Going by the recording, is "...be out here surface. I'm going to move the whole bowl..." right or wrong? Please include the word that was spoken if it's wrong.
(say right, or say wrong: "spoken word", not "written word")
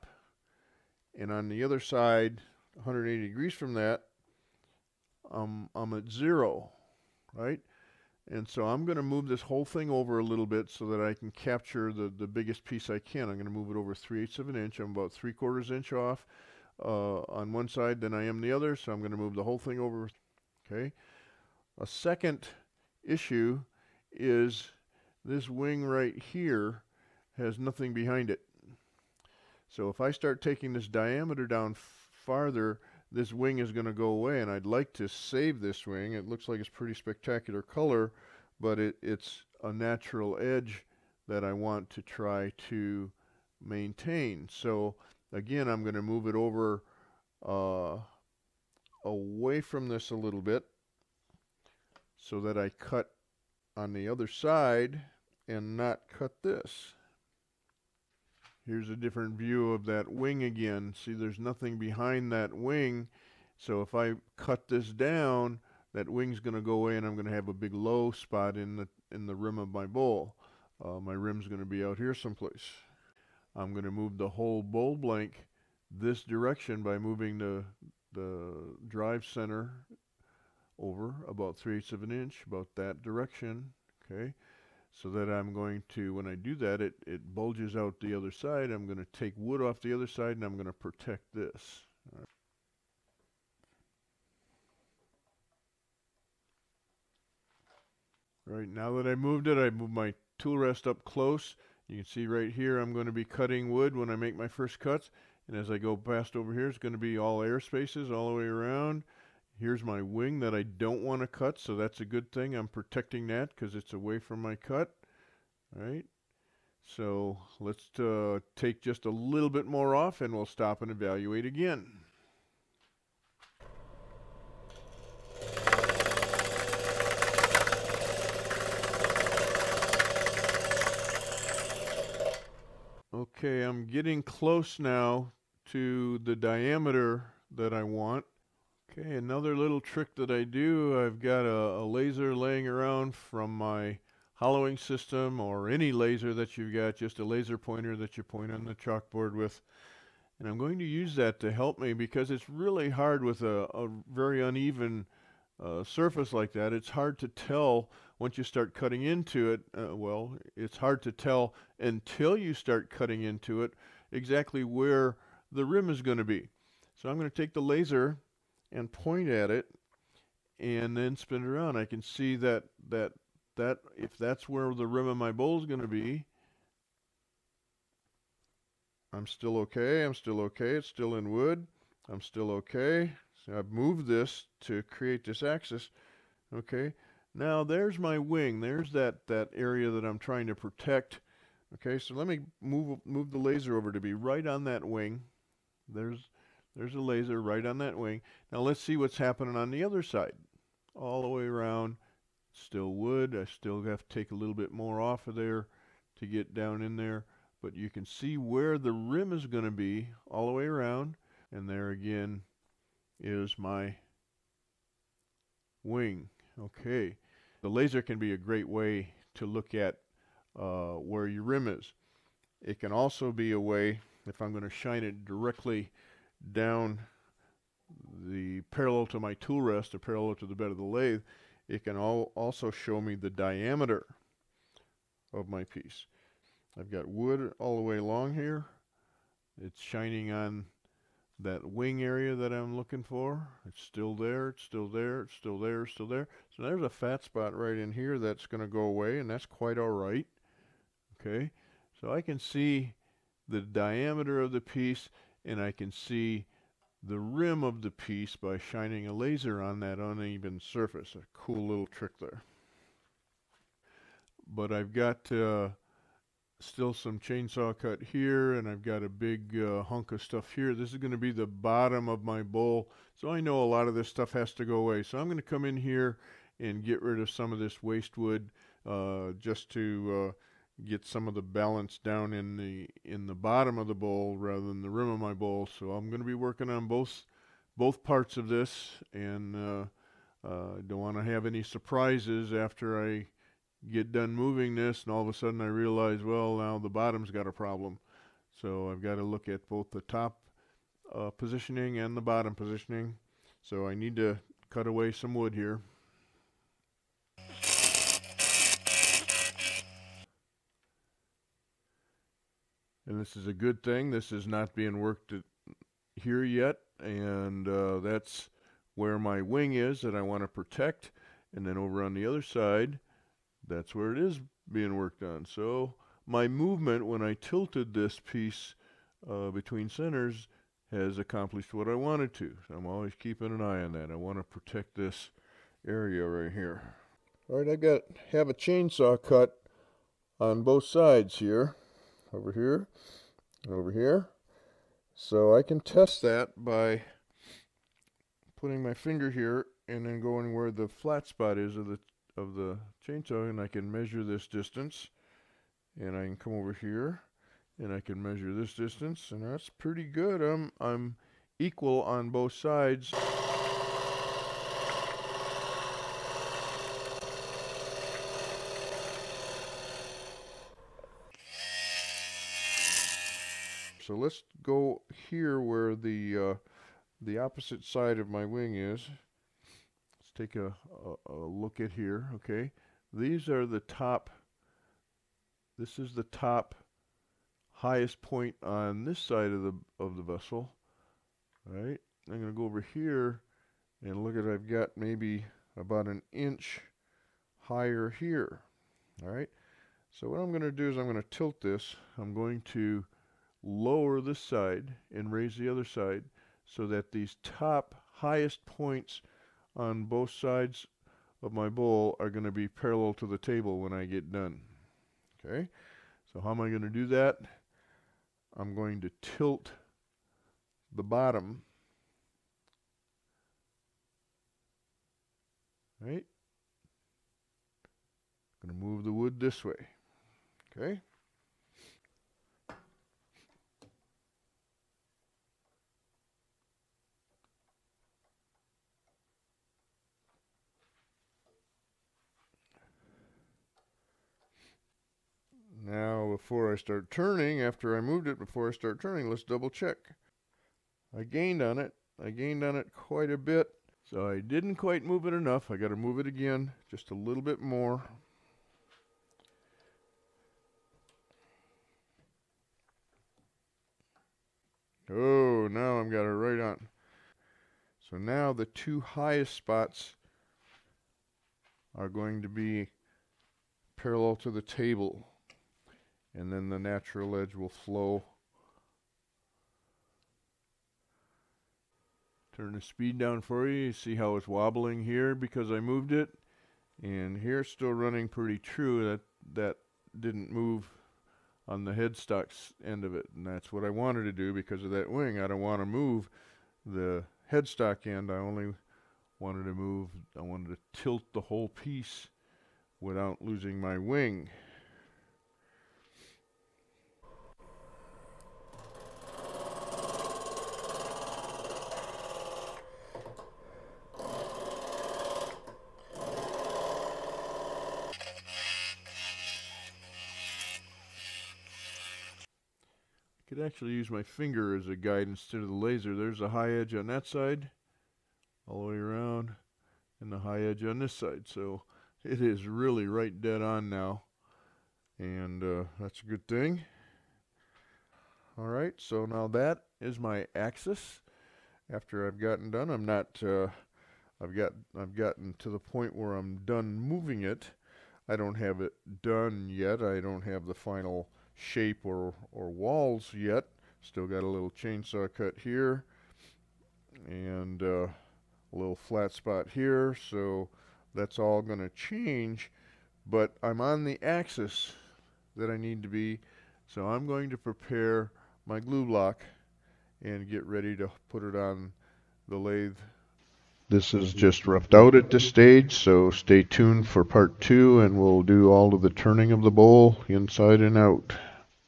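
wrong: "someplace", not "surface".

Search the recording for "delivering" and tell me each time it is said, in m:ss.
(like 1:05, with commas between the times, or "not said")
not said.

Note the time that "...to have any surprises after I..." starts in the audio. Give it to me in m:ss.
4:51.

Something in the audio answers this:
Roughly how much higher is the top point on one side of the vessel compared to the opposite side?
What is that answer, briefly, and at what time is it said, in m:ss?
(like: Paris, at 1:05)
about an inch, at 6:35.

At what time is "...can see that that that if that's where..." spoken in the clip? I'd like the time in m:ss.
2:51.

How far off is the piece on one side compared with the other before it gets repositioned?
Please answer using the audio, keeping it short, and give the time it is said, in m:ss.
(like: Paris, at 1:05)
3/4 inch, at 0:15.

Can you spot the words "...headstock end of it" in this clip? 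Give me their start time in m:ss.
8:11.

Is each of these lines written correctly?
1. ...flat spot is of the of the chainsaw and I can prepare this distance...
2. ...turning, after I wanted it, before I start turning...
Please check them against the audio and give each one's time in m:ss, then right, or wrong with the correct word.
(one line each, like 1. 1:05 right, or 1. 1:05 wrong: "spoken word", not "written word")
1. 5:50 wrong: "measure", not "prepare"
2. 7:27 wrong: "moved", not "wanted".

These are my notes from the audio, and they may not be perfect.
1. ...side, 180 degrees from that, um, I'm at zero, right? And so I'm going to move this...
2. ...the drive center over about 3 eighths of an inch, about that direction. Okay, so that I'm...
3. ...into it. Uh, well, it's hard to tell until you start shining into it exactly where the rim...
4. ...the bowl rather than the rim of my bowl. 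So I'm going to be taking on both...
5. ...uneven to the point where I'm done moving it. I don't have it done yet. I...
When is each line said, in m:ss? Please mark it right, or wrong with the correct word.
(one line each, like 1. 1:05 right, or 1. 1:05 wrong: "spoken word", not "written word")
1. 0:01 right
2. 1:18 right
3. 2:39 wrong: "cutting", not "shining"
4. 4:43 wrong: "working", not "taking"
5. 9:05 wrong: "gotten", not "uneven".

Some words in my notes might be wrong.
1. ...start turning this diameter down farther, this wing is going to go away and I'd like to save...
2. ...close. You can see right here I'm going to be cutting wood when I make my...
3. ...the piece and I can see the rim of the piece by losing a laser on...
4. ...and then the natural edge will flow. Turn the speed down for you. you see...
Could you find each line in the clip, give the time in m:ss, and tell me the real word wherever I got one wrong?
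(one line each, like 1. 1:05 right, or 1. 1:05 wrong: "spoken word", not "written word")
1. 0:30 wrong: "taking", not "turning"
2. 1:41 right
3. 4:14 wrong: "shining", not "losing"
4. 7:56 right.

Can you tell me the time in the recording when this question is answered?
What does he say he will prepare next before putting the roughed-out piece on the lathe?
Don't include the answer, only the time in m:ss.
9:28.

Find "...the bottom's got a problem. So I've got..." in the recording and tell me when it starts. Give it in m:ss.
4:56.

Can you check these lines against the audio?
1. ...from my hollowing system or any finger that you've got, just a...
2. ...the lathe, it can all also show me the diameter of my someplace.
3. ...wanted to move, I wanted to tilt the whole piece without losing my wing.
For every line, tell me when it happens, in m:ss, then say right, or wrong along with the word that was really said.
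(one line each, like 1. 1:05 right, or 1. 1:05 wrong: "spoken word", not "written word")
1. 2:23 wrong: "laser", not "finger"
2. 3:50 wrong: "piece", not "someplace"
3. 8:19 right.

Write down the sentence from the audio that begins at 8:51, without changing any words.
So it is really right dead on now, and uh, that's a good thing.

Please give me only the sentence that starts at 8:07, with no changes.
And here still running pretty true.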